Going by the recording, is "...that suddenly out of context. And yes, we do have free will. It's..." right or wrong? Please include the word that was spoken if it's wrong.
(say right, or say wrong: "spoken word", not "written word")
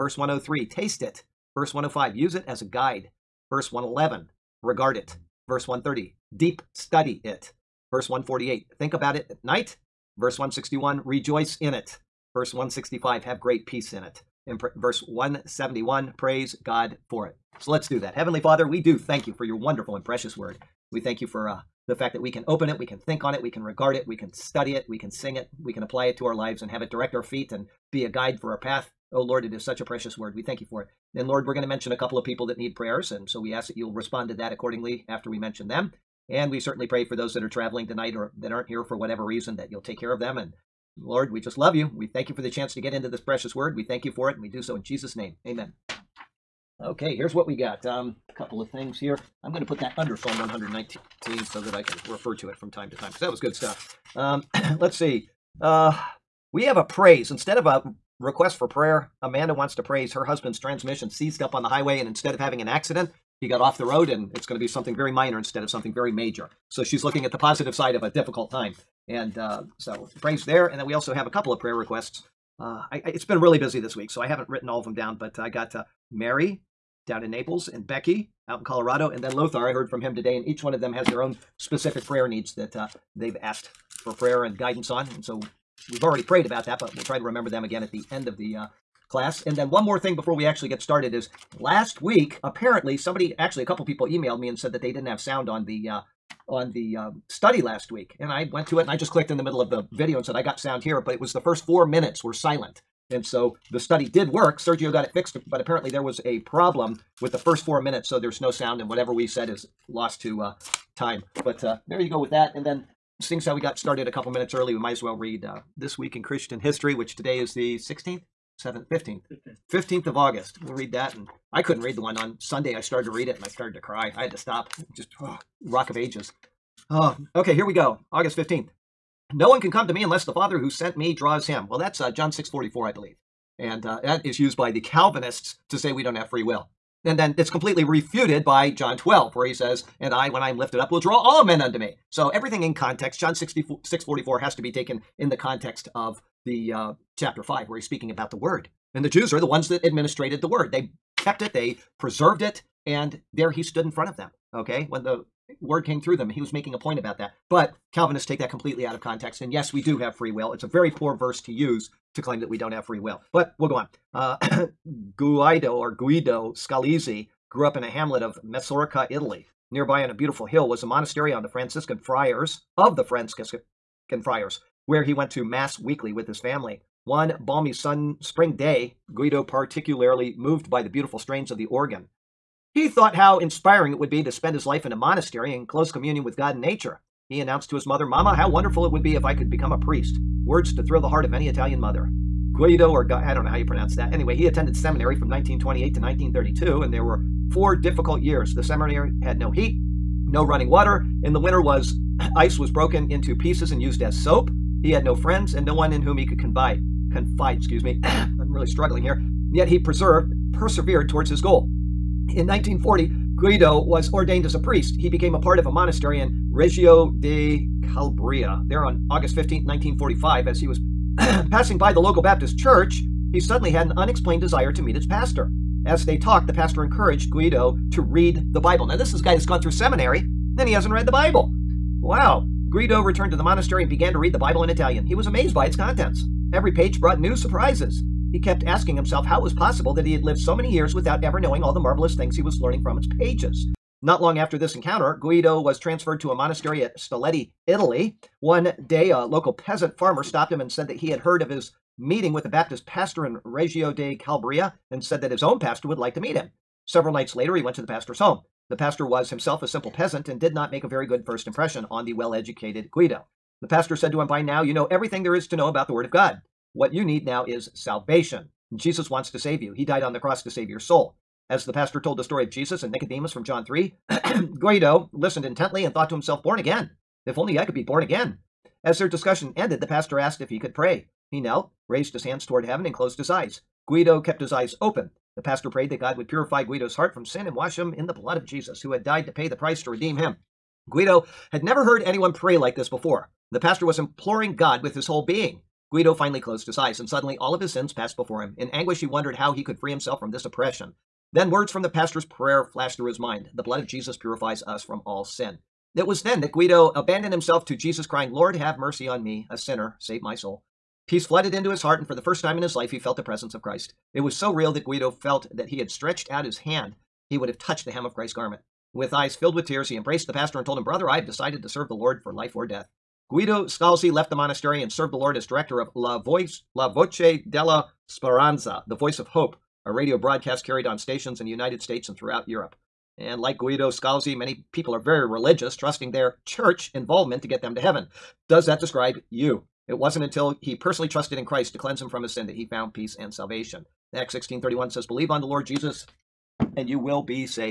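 wrong: "completely", not "suddenly".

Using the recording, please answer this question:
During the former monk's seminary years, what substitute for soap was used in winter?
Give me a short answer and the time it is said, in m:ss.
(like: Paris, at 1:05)
Ice, at 3:22.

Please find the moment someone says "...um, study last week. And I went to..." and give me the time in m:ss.
1:36.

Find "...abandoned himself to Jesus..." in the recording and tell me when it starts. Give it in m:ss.
5:06.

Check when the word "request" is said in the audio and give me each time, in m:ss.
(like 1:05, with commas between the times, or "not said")
0:58, 1:11.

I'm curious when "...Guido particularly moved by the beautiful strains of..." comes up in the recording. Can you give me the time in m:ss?
2:59.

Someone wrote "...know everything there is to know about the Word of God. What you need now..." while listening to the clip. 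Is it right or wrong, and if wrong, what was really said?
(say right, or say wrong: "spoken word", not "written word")
right.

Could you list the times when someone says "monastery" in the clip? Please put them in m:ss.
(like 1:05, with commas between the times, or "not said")
2:50, 3:04, 3:35, 3:53, 4:06, 5:24.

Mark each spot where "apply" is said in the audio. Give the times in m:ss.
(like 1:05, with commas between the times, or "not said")
0:25.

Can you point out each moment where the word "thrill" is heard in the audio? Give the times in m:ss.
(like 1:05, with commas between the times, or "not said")
3:10.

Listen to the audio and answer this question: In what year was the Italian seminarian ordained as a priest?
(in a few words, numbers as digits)
1940.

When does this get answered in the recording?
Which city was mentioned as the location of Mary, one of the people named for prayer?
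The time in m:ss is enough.
1:17.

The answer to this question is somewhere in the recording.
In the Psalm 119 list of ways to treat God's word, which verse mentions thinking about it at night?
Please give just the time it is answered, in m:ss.
0:07.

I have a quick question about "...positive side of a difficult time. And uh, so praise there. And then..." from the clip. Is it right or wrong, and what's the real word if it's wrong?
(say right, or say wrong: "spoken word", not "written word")
right.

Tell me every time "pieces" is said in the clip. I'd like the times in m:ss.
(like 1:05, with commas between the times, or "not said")
3:23.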